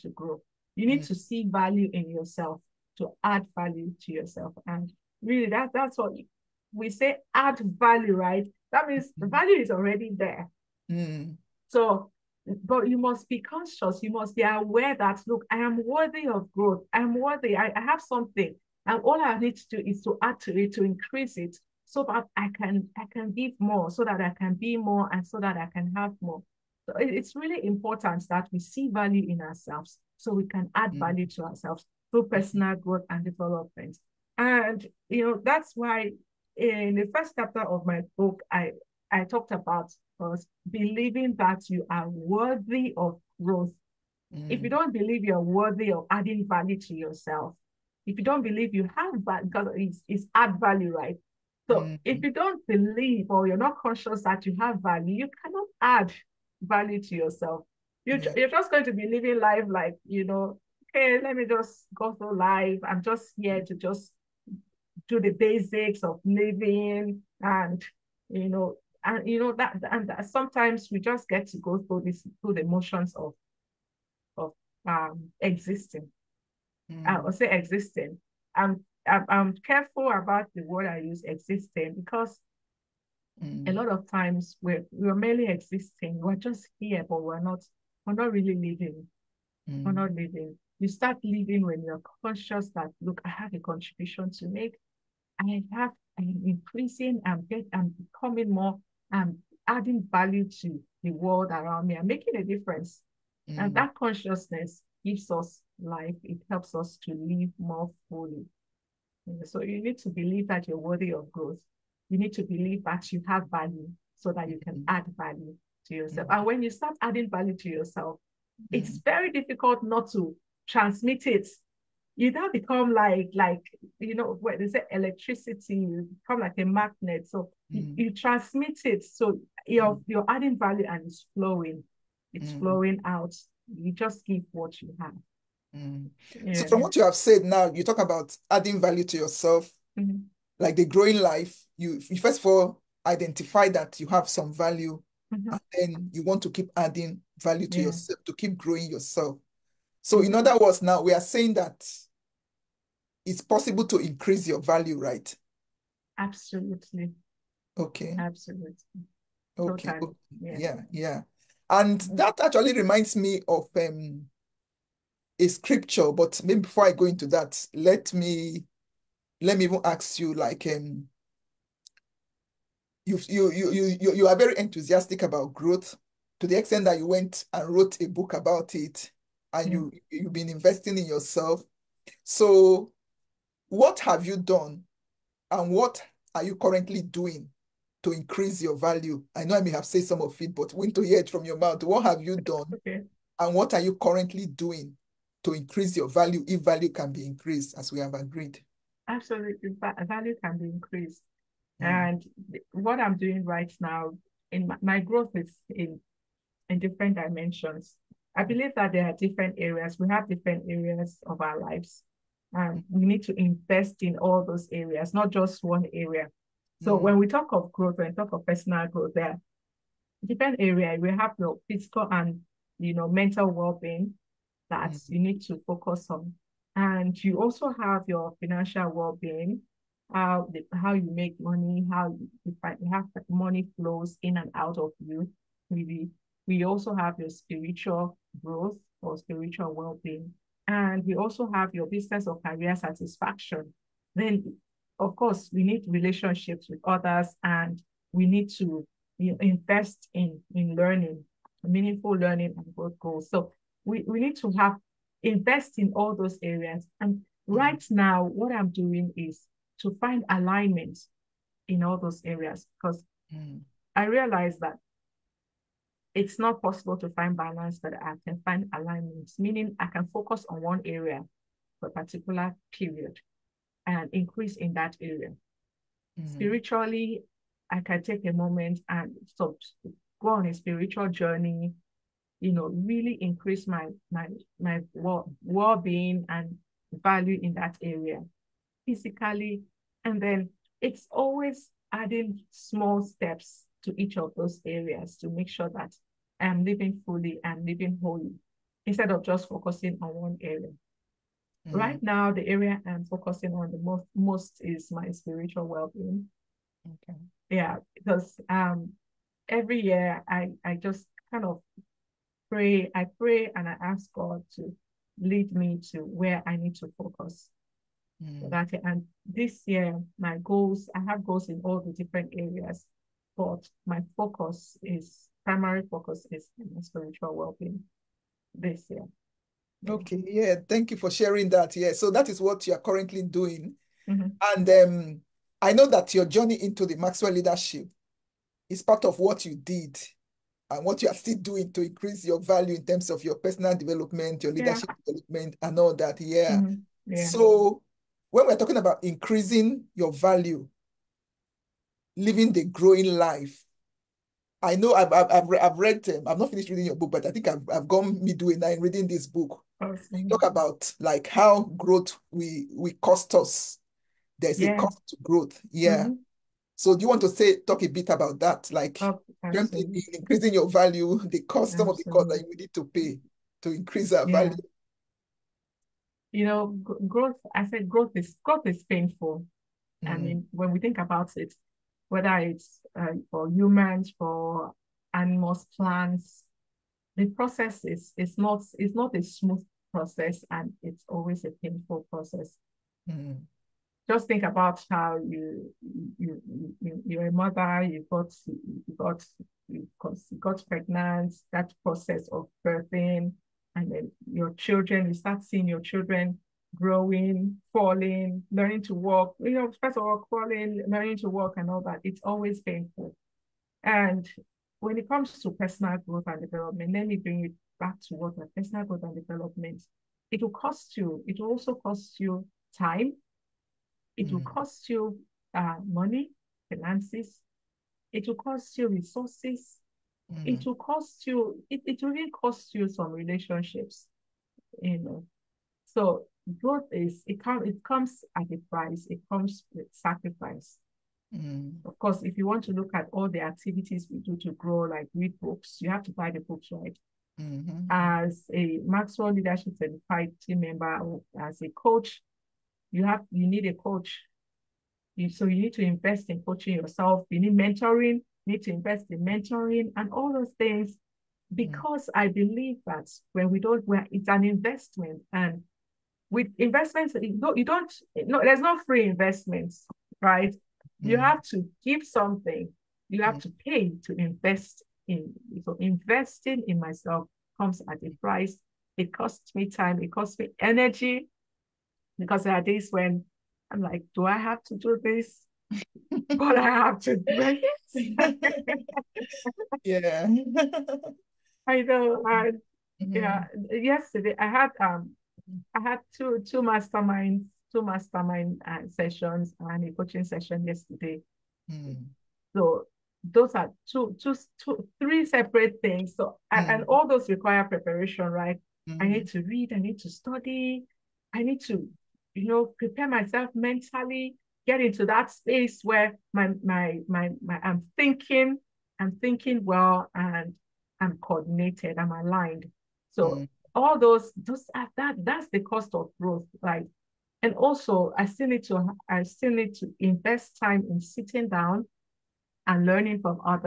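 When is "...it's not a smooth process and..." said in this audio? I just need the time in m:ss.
6:28.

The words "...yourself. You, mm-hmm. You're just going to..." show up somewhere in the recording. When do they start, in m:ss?
0:57.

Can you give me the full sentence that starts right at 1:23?
a lot of times we're we're merely existing.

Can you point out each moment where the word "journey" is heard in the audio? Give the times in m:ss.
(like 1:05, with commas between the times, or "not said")
4:41, 5:36.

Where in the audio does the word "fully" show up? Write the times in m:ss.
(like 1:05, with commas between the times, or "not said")
1:48, 4:57.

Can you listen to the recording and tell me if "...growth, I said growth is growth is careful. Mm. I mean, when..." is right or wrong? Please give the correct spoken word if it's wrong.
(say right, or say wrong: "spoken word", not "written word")
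wrong: "painful", not "careful".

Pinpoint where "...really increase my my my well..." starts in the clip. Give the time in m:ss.
4:42.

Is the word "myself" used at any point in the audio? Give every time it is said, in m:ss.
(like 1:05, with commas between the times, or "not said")
7:56, 8:33.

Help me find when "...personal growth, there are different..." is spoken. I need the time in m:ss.
3:38.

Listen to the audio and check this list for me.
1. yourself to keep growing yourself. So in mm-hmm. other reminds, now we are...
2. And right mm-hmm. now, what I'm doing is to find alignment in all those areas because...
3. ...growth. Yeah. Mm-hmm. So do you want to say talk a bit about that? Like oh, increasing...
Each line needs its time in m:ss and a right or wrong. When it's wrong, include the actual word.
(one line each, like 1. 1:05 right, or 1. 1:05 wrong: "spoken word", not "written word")
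1. 2:27 wrong: "words", not "reminds"
2. 4:16 right
3. 6:05 right.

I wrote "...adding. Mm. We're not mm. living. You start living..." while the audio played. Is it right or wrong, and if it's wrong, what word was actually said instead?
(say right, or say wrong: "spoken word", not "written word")
wrong: "living", not "adding".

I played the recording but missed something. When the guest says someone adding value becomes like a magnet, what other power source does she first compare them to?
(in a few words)
electricity.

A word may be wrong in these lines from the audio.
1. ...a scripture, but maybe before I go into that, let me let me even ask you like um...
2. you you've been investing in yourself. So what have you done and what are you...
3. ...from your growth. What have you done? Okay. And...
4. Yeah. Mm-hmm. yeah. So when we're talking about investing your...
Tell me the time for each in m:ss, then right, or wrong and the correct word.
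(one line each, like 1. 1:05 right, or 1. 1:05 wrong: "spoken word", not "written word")
1. 2:45 right
2. 2:59 right
3. 3:11 wrong: "mouth", not "growth"
4. 5:46 wrong: "increasing", not "investing".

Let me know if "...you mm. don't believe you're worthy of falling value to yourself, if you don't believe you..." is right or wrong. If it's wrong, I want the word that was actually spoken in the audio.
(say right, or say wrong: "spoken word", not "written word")
wrong: "adding", not "falling".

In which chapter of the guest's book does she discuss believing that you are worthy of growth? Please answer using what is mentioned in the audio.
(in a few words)
first chapter.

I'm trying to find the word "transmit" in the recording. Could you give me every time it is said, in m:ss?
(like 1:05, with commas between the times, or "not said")
2:00, 2:08.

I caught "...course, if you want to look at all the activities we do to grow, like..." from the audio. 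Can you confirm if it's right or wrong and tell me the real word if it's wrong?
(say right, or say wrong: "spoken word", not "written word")
right.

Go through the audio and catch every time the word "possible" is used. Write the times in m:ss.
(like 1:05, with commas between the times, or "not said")
2:33, 4:26.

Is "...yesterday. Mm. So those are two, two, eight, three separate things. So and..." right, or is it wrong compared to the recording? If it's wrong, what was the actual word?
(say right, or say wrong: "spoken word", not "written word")
wrong: "two", not "eight".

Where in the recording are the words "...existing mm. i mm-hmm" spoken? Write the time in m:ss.
1:15.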